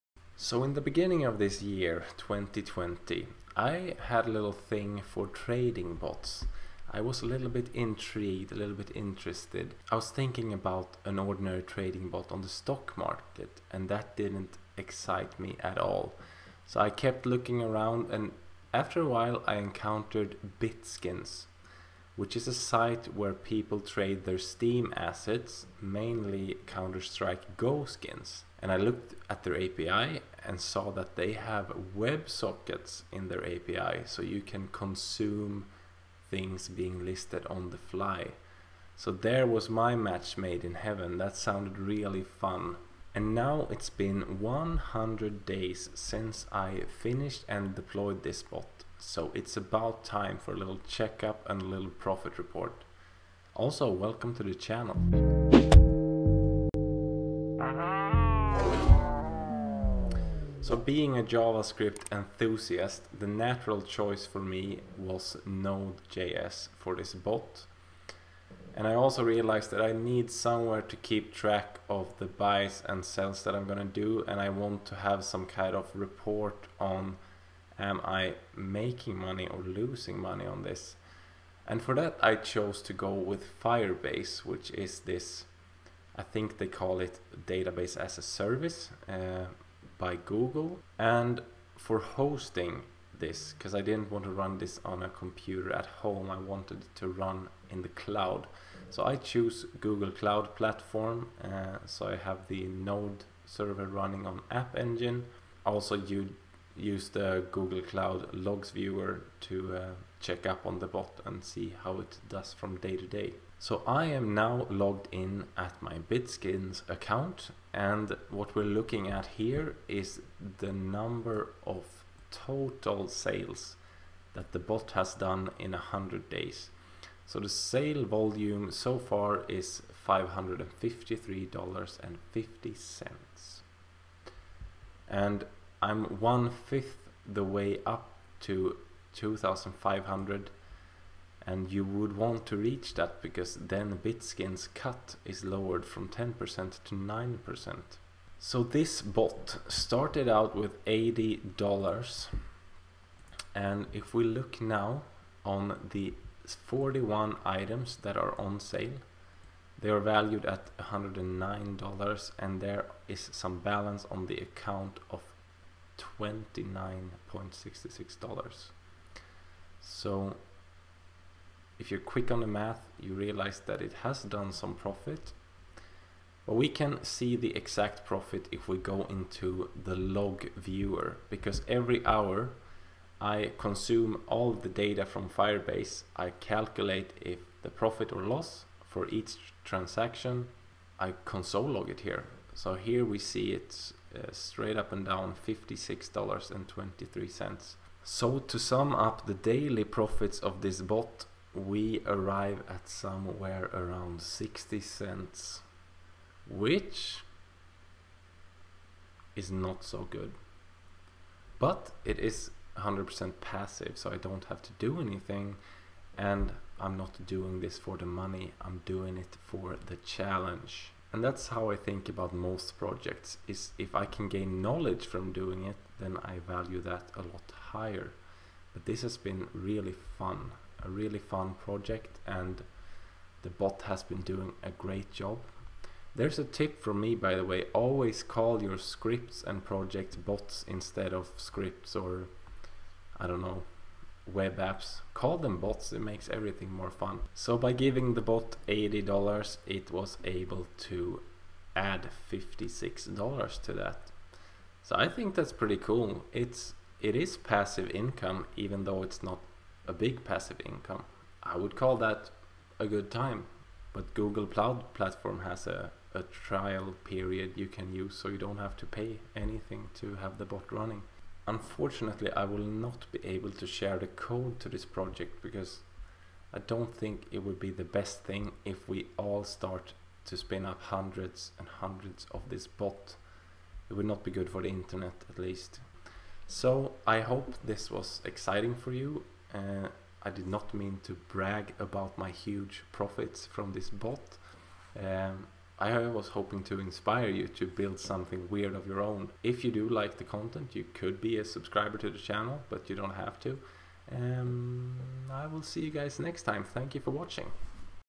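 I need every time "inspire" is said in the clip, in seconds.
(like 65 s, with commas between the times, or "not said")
296 s.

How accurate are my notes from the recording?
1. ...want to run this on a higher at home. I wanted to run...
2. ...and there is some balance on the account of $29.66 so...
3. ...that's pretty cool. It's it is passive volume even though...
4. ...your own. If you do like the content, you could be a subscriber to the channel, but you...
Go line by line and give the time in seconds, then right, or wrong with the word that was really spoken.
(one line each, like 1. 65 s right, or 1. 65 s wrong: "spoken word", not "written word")
1. 94 s wrong: "computer", not "higher"
2. 162 s right
3. 255 s wrong: "income", not "volume"
4. 298 s right.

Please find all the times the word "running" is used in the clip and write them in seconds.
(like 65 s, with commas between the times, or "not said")
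103 s, 270 s.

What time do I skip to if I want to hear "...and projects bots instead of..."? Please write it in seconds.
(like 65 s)
239 s.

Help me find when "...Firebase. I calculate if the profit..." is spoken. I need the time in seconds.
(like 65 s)
185 s.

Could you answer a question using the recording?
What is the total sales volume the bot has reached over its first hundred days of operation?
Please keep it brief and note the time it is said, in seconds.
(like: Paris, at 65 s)
$553.50, at 130 s.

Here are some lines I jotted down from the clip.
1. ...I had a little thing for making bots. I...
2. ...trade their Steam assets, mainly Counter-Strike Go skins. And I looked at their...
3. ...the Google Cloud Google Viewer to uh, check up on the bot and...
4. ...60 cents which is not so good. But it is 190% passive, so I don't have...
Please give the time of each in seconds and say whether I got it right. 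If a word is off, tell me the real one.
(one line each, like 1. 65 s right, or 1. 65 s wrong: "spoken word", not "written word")
1. 3 s wrong: "trading", not "making"
2. 23 s right
3. 107 s wrong: "Logs", not "Google"
4. 204 s wrong: "100", not "190".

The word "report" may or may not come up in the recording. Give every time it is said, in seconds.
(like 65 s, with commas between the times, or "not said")
52 s, 75 s.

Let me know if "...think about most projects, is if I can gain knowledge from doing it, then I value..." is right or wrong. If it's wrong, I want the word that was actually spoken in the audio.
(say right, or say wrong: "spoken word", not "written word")
right.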